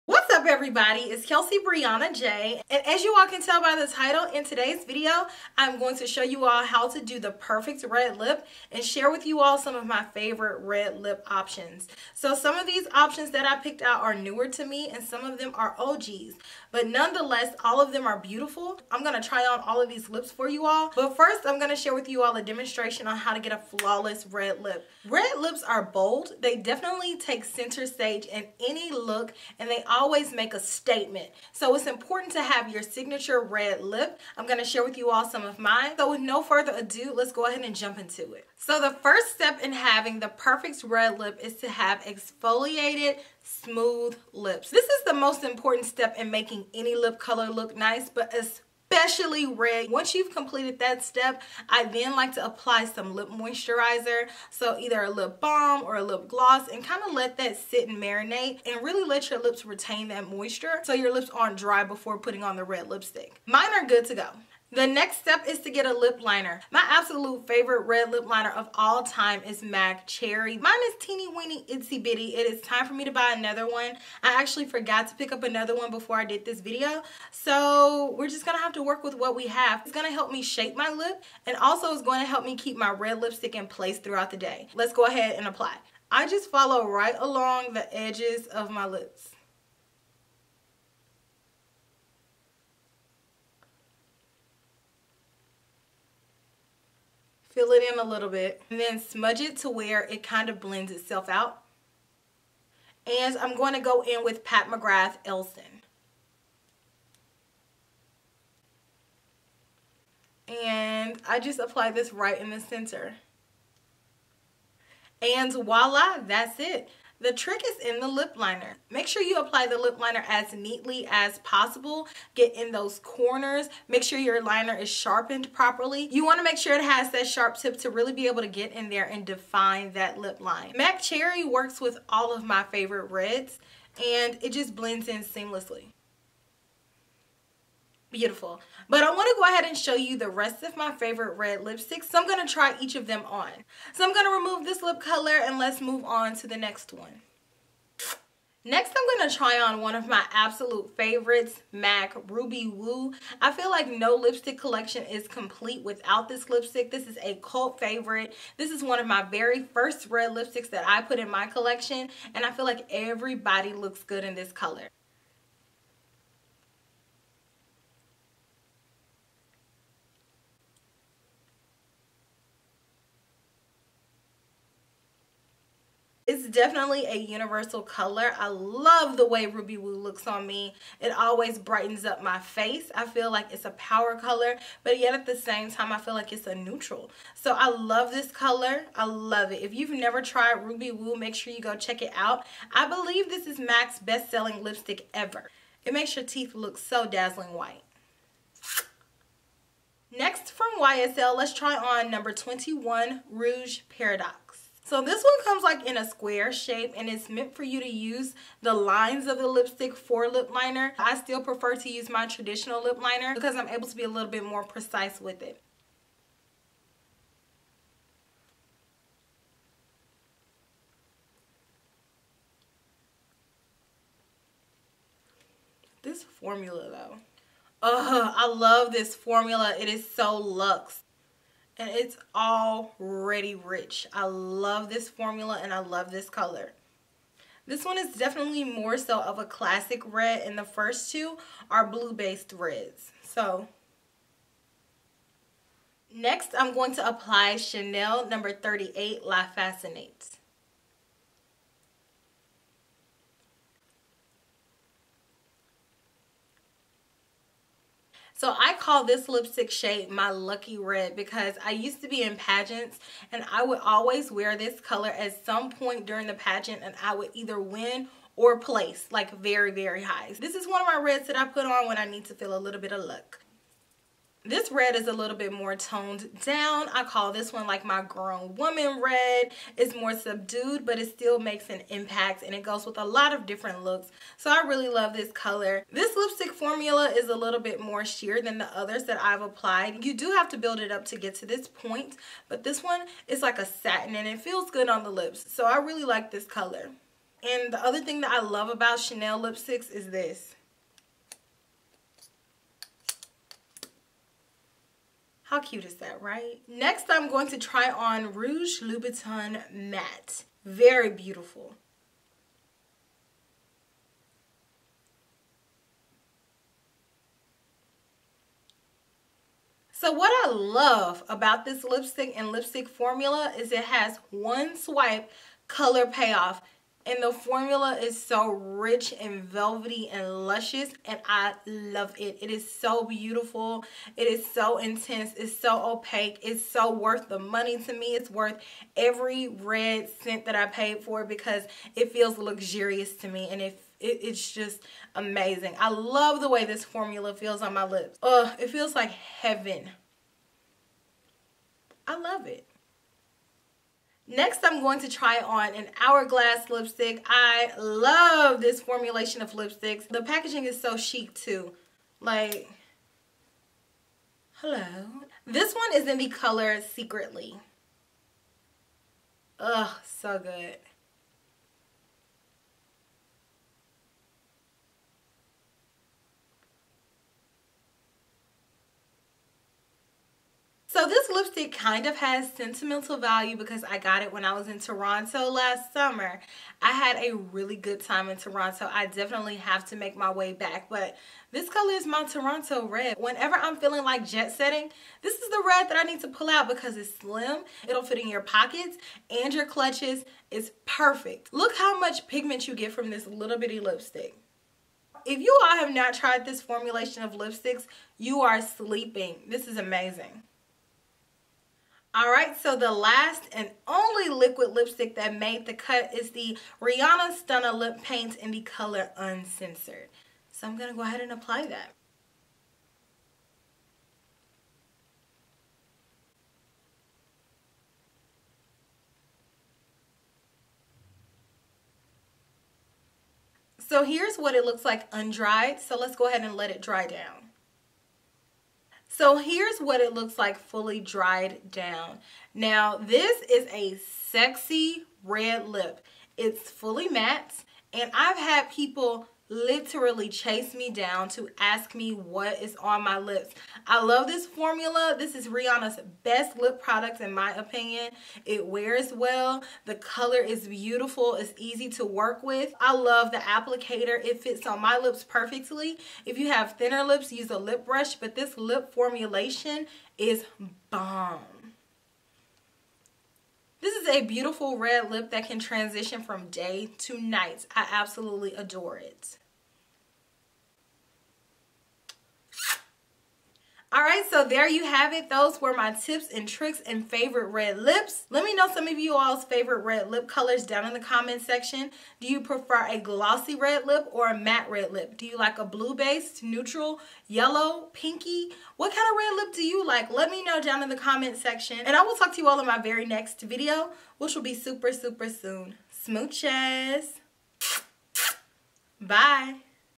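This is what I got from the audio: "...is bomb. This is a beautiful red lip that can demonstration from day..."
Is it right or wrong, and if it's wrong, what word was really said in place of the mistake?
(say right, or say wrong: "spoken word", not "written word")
wrong: "transition", not "demonstration".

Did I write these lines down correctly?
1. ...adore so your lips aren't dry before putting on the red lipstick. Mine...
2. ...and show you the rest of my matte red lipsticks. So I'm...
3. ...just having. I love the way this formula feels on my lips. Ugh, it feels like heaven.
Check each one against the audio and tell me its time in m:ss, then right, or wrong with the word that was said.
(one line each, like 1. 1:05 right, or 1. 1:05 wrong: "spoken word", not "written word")
1. 1:00 wrong: "moisture", not "adore"
2. 2:19 wrong: "favorite", not "matte"
3. 5:44 wrong: "amazing", not "having".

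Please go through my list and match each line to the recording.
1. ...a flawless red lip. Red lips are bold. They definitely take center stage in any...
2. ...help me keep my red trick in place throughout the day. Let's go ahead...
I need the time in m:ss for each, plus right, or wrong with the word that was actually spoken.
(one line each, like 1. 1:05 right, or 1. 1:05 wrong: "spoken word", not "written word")
1. 0:23 right
2. 1:22 wrong: "lipstick", not "trick".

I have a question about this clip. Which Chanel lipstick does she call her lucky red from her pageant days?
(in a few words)
La Fascinante.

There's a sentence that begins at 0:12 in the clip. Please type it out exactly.
So some of these options that I picked out are newer to me and some of them are OGs.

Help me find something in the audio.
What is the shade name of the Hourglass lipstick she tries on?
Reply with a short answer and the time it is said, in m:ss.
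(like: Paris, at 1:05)
Secretly, at 6:06.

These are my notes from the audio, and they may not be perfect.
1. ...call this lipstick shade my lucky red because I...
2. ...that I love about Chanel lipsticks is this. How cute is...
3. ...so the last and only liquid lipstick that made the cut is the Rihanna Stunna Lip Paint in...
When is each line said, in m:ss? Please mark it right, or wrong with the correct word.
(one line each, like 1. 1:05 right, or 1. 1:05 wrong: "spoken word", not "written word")
1. 4:18 right
2. 4:58 right
3. 6:52 right.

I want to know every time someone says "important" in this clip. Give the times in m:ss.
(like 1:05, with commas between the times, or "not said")
0:31, 0:45.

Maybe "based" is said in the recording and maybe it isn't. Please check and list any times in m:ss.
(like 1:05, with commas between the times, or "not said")
4:02, 8:15.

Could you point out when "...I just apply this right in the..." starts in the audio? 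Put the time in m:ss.
1:51.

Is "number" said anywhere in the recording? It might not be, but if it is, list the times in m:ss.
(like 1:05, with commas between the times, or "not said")
3:22, 4:08.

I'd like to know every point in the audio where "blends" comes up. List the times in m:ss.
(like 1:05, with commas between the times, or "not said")
1:40, 2:14.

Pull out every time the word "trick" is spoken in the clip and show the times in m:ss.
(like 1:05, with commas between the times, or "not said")
1:57, 8:06.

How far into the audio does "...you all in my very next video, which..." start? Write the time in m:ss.
8:22.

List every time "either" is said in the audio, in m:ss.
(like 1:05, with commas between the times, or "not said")
0:54, 4:27.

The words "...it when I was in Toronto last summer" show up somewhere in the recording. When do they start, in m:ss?
6:24.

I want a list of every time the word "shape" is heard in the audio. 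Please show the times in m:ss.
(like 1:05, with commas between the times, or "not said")
1:20, 3:26.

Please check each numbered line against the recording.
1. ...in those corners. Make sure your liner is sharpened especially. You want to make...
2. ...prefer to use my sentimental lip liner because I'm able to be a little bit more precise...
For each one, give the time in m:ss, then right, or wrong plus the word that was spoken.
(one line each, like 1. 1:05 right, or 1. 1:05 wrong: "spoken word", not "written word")
1. 2:02 wrong: "properly", not "especially"
2. 3:31 wrong: "traditional", not "sentimental".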